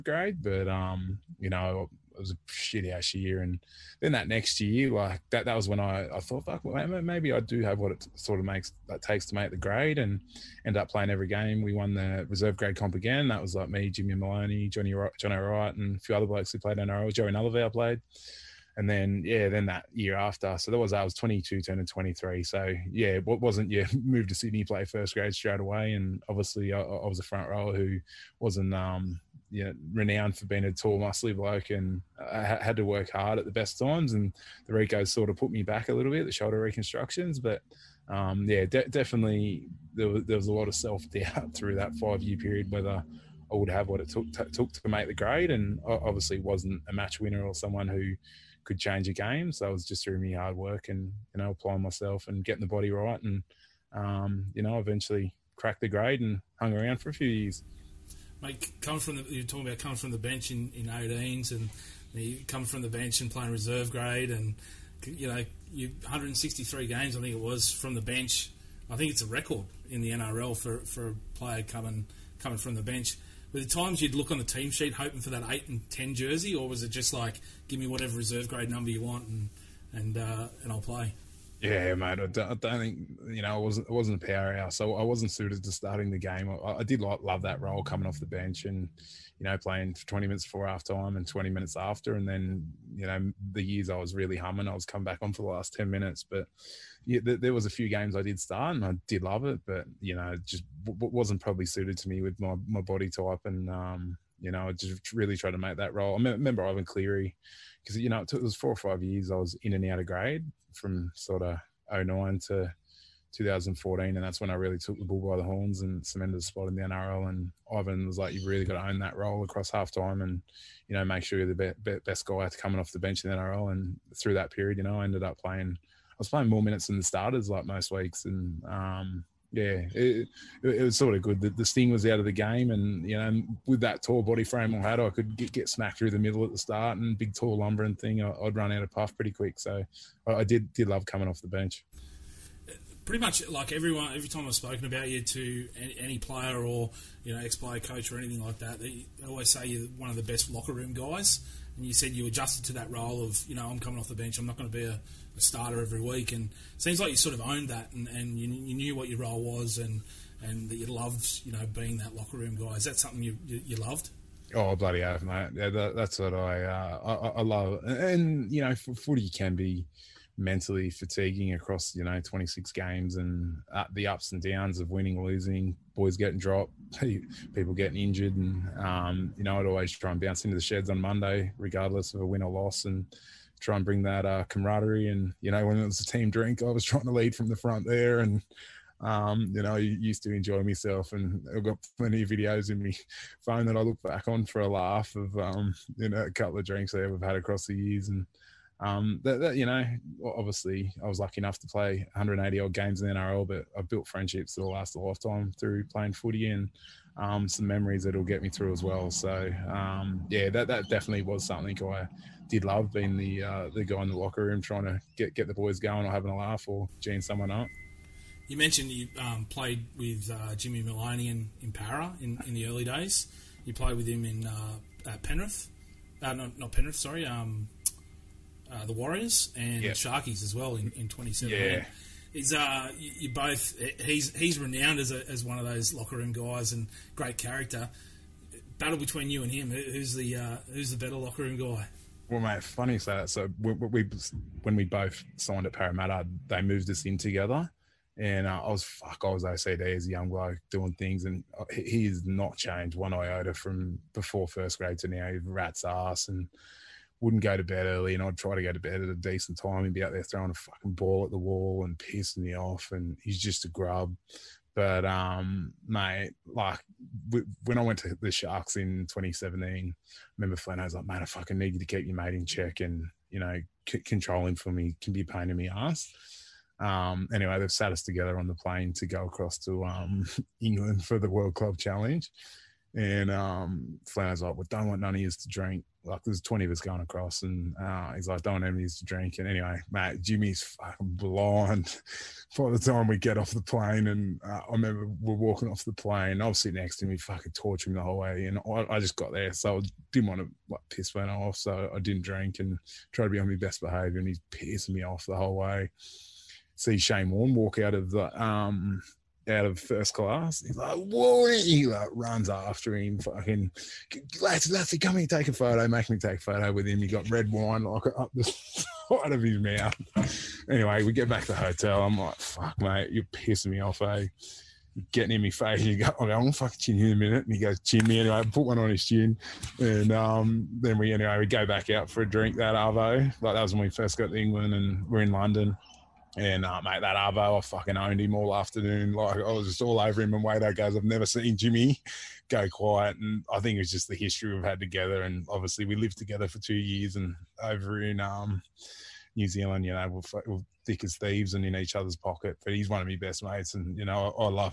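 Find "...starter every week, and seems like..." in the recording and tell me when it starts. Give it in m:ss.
2:35.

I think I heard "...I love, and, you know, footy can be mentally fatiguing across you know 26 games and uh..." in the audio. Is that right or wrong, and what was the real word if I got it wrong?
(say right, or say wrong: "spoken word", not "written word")
right.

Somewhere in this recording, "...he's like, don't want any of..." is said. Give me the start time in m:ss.
4:48.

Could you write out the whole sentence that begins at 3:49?
Sharkies as well in, in 2017.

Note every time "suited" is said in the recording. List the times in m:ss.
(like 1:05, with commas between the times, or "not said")
1:25, 1:41.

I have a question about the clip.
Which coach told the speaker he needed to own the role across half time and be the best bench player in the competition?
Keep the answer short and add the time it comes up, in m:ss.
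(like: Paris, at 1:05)
Ivan Cleary, at 1:46.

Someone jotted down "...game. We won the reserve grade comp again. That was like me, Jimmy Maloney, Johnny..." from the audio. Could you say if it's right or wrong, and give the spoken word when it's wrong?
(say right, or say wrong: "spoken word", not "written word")
right.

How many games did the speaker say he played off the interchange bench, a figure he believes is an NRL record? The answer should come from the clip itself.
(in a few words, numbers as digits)
163.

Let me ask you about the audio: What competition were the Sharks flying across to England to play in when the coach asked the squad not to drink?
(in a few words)
World Club Challenge.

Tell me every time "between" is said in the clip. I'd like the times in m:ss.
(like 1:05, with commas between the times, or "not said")
3:58.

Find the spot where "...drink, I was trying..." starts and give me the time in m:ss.
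3:06.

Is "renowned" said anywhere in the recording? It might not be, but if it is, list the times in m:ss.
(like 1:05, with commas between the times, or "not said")
0:29, 3:54.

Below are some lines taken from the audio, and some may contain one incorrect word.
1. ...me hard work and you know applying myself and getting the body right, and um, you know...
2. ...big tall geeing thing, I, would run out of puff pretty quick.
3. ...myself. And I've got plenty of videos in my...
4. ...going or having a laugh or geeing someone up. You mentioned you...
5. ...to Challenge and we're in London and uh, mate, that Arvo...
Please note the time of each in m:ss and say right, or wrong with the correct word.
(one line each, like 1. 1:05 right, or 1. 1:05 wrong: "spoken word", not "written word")
1. 0:50 right
2. 2:17 wrong: "lumbering", not "geeing"
3. 3:10 right
4. 3:35 right
5. 5:34 wrong: "England", not "Challenge".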